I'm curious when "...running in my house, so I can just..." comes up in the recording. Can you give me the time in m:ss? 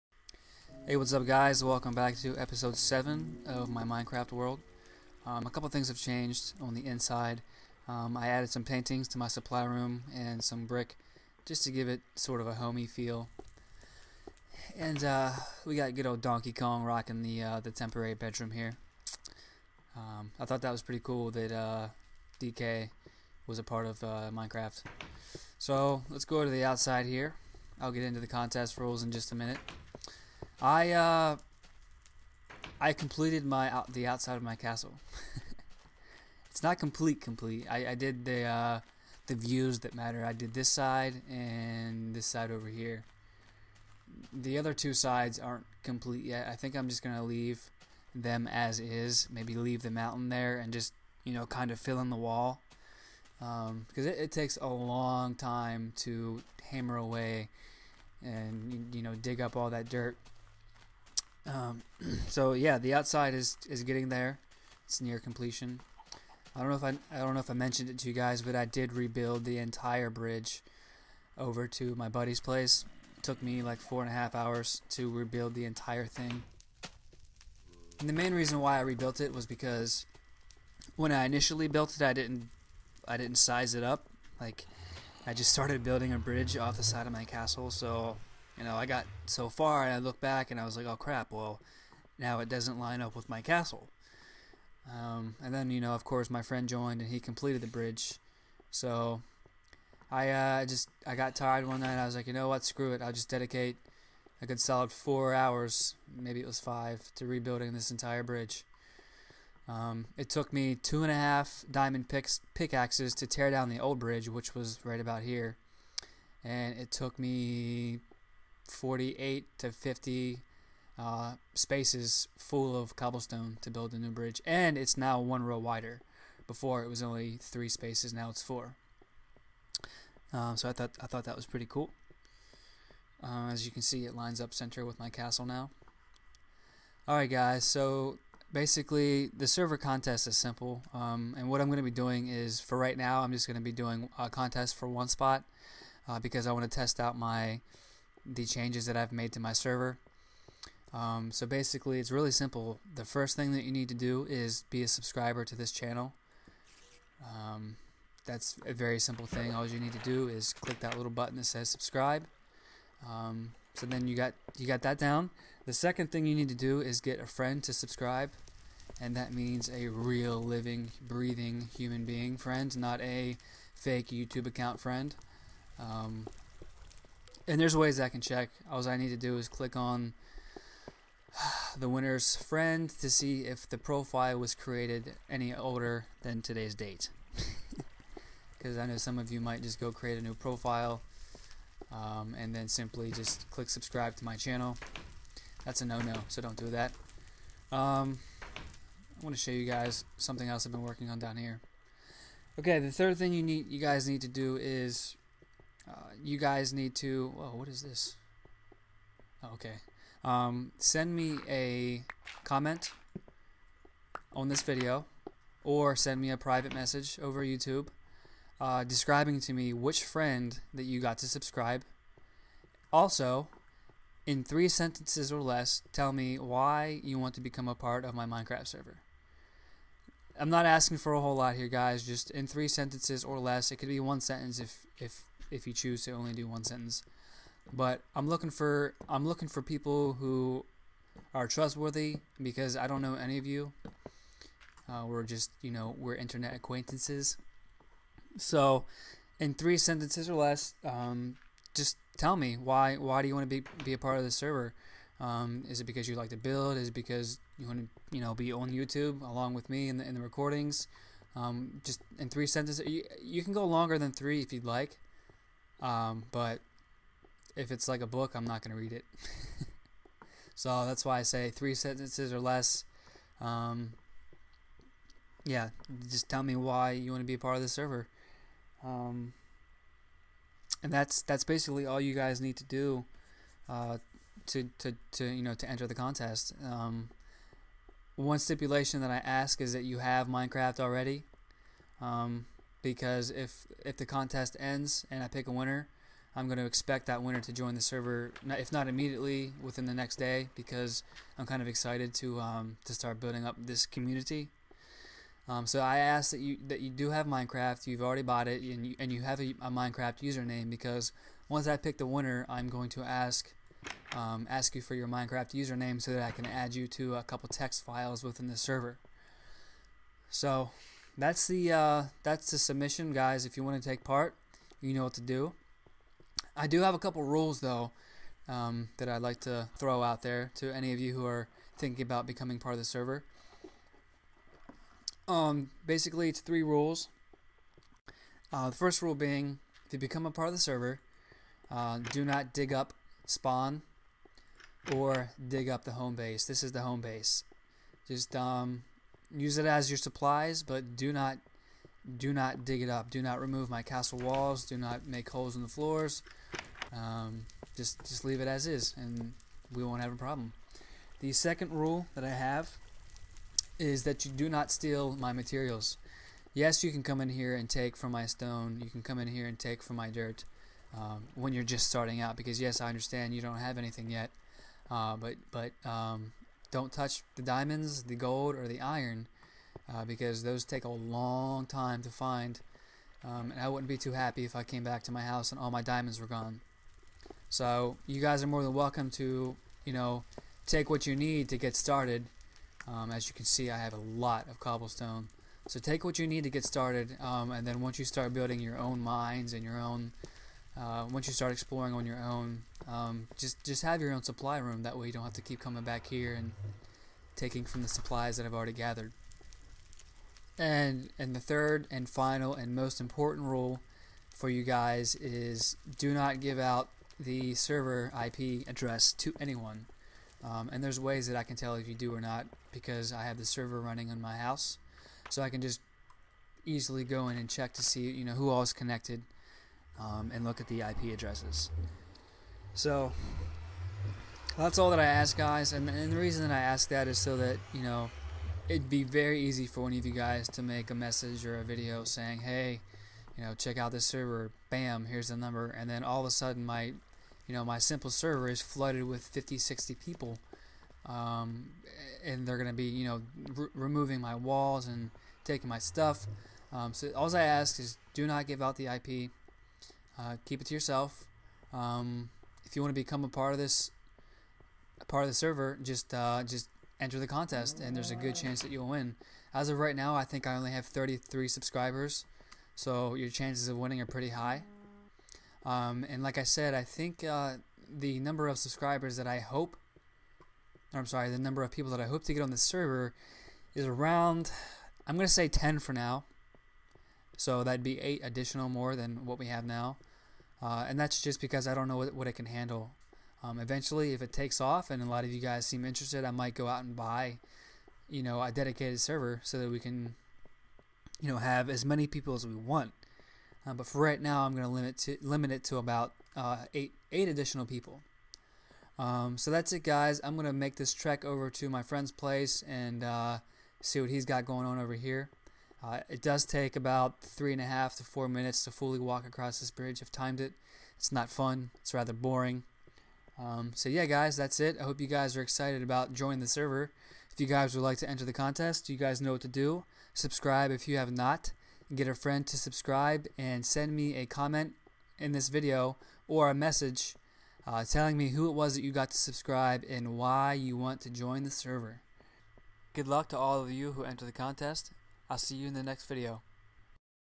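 7:03.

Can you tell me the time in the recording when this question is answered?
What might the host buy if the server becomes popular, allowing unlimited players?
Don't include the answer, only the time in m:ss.
8:18.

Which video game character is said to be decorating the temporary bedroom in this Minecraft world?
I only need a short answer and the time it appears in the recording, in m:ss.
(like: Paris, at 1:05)
Donkey Kong, at 0:16.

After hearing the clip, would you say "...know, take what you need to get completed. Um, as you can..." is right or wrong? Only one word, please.
wrong.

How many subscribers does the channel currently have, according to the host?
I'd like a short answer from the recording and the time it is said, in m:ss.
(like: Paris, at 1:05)
33, at 7:50.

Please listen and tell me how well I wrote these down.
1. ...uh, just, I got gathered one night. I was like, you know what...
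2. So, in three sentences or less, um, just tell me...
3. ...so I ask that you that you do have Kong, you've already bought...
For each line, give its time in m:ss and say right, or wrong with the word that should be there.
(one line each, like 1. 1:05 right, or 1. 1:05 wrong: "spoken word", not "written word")
1. 1:40 wrong: "tired", not "gathered"
2. 4:08 right
3. 5:05 wrong: "Minecraft", not "Kong".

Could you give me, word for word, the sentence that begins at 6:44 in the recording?
That way you don't have to keep coming back here and taking from the supplies that I've already gathered.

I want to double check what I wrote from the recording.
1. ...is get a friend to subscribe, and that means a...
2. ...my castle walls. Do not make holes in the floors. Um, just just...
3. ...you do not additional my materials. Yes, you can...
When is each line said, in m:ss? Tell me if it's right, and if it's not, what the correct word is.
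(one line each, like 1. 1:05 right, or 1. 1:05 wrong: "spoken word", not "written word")
1. 2:46 right
2. 5:53 right
3. 6:04 wrong: "steal", not "additional".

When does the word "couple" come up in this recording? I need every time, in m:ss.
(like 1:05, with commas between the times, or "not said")
0:05, 5:17, 5:26.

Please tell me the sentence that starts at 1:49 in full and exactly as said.
Um, it took me two and a half diamond picks, pickaxes to tear down the old bridge, which was right about here.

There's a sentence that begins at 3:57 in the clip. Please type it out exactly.
But I'm looking for I'm looking for people who are trustworthy because I don't know any of you.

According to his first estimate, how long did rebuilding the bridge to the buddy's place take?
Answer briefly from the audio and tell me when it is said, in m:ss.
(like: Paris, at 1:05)
4 and a half hours, at 1:13.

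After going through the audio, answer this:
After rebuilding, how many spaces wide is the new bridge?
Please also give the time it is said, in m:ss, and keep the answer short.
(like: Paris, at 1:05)
4, at 2:08.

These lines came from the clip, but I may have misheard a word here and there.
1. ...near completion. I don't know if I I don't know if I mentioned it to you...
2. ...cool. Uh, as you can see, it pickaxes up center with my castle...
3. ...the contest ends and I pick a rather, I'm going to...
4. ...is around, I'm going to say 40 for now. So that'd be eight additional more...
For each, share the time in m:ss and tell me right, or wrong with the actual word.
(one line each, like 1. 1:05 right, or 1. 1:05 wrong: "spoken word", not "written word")
1. 1:05 right
2. 2:11 wrong: "lines", not "pickaxes"
3. 4:53 wrong: "winner", not "rather"
4. 8:03 wrong: "10", not "40".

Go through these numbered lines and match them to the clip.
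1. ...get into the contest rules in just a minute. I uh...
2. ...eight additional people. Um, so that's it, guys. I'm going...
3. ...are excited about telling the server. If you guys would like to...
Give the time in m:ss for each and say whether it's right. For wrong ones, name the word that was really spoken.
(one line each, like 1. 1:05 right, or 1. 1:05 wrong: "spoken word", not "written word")
1. 0:27 right
2. 8:27 right
3. 8:45 wrong: "joining", not "telling".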